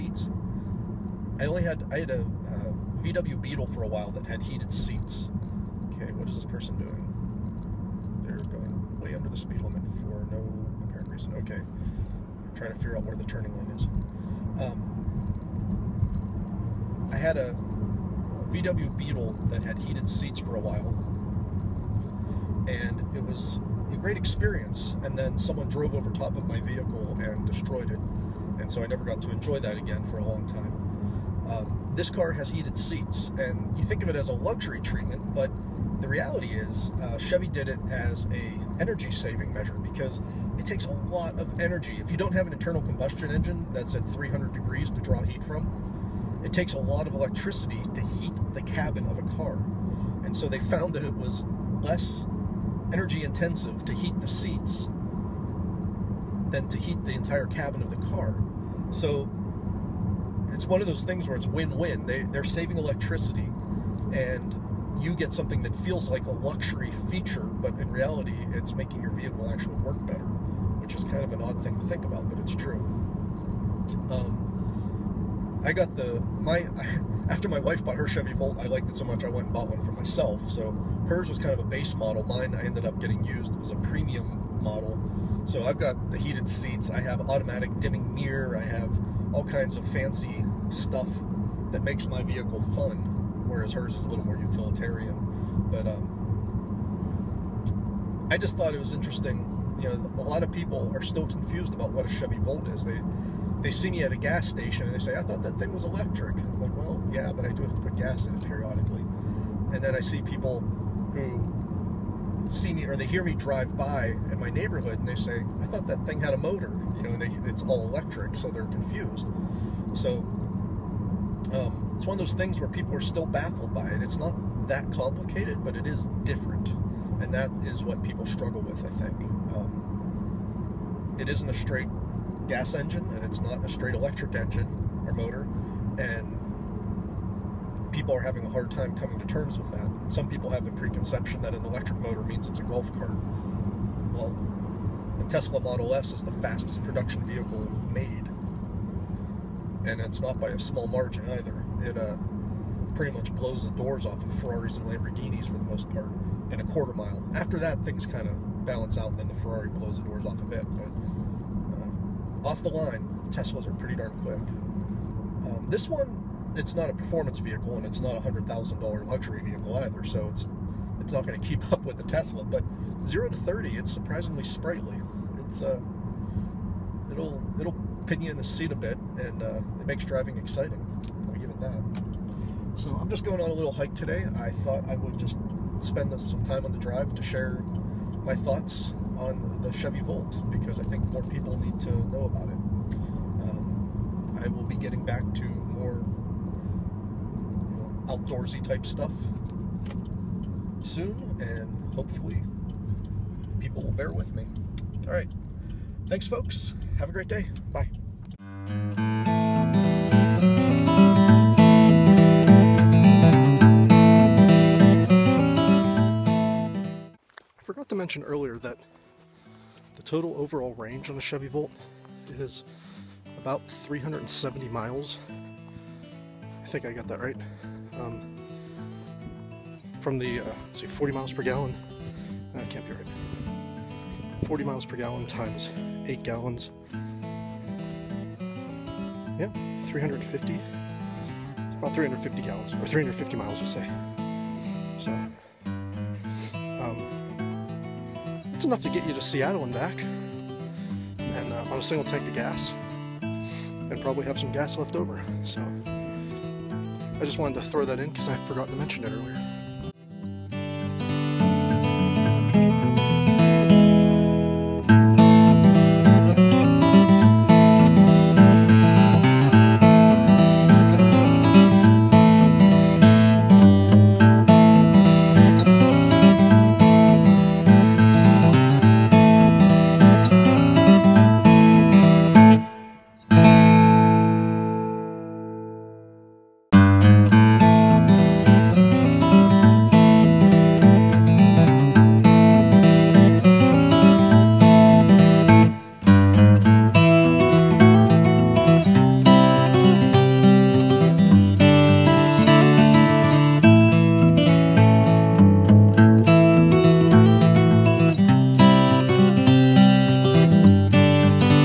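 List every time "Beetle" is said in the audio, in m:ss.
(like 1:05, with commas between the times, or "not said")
0:03, 0:18.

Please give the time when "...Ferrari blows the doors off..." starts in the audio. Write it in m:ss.
2:39.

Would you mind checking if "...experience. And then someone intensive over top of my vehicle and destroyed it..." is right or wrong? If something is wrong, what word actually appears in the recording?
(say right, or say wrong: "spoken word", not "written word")
wrong: "drove", not "intensive".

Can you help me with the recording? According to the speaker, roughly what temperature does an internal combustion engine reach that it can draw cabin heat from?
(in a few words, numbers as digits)
300 degrees.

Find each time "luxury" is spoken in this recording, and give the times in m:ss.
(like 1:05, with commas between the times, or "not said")
0:34, 1:06, 2:49.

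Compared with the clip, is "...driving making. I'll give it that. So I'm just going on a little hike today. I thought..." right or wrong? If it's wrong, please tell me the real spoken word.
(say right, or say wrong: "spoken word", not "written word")
wrong: "exciting", not "making".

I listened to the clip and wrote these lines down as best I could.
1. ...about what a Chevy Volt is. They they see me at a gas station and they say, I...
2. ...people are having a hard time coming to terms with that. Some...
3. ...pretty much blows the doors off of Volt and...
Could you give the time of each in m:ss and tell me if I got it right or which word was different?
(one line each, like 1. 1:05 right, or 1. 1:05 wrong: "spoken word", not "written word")
1. 1:41 right
2. 2:17 right
3. 2:32 wrong: "Ferraris", not "Volt".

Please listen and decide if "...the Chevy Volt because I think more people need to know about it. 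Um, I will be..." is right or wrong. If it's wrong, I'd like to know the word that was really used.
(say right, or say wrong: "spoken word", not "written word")
right.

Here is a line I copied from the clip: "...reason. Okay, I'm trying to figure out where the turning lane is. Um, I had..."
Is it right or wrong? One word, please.
right.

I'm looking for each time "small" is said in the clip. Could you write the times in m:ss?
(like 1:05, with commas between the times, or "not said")
2:30.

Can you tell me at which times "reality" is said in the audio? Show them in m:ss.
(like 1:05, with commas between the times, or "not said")
0:36, 1:07.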